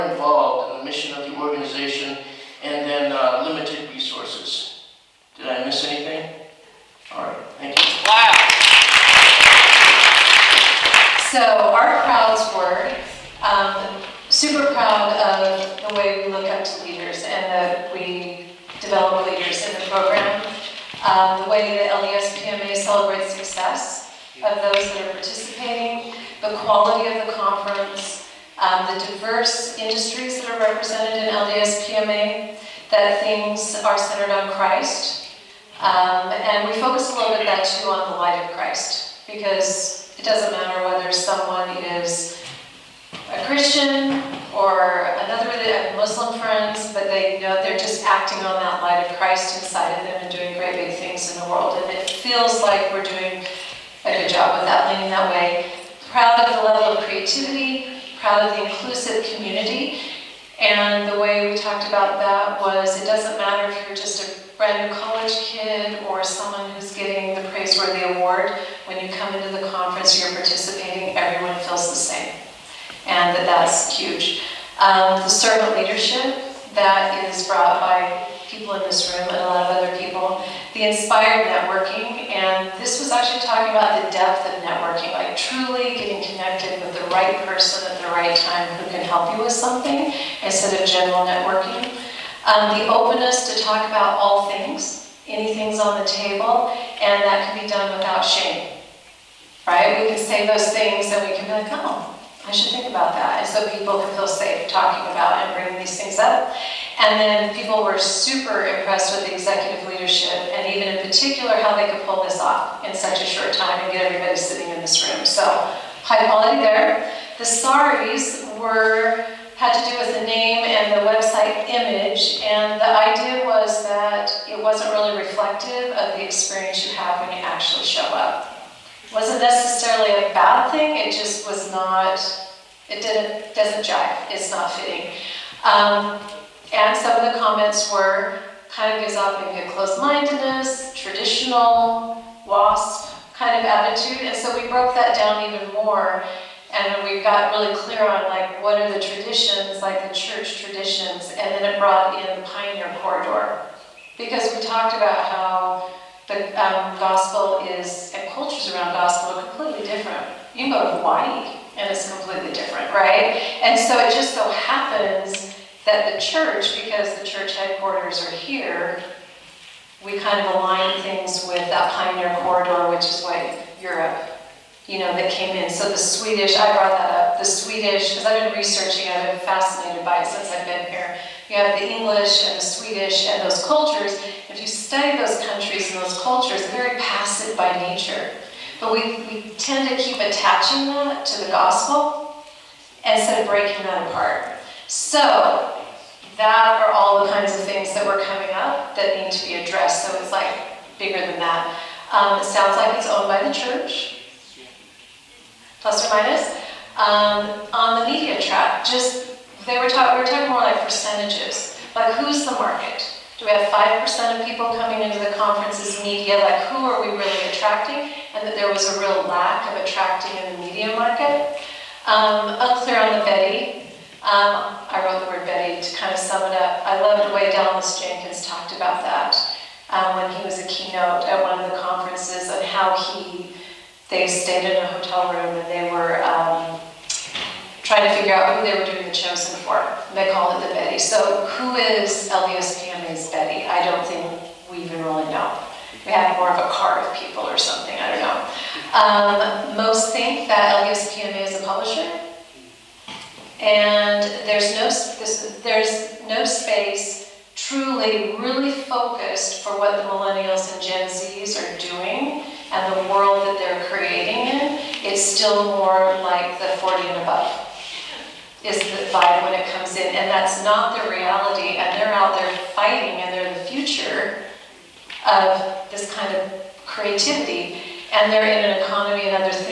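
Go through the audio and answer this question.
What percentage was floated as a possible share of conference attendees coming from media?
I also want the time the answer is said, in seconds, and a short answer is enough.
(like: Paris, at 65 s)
5%, at 213 s.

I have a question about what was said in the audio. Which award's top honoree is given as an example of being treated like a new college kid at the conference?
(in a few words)
Praiseworthy Award.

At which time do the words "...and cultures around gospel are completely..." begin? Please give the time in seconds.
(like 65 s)
158 s.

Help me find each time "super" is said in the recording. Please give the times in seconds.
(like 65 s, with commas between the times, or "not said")
14 s, 107 s.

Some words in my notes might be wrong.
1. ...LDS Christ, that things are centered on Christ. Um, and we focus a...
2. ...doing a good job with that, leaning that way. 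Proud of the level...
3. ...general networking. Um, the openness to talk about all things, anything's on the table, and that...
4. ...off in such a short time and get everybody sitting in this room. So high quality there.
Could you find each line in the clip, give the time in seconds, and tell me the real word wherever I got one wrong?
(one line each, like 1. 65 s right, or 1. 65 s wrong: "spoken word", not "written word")
1. 31 s wrong: "PMA", not "Christ"
2. 53 s right
3. 90 s right
4. 112 s right.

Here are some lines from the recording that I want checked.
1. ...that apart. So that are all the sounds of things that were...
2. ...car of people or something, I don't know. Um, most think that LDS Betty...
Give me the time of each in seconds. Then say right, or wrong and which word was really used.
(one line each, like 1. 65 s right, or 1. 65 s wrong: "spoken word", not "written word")
1. 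193 s wrong: "kinds", not "sounds"
2. 246 s wrong: "PMA", not "Betty".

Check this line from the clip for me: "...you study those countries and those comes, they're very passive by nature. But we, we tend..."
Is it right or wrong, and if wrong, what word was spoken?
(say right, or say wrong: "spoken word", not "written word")
wrong: "cultures", not "comes".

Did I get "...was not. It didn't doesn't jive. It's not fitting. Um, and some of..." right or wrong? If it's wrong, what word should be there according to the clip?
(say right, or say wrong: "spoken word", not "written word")
right.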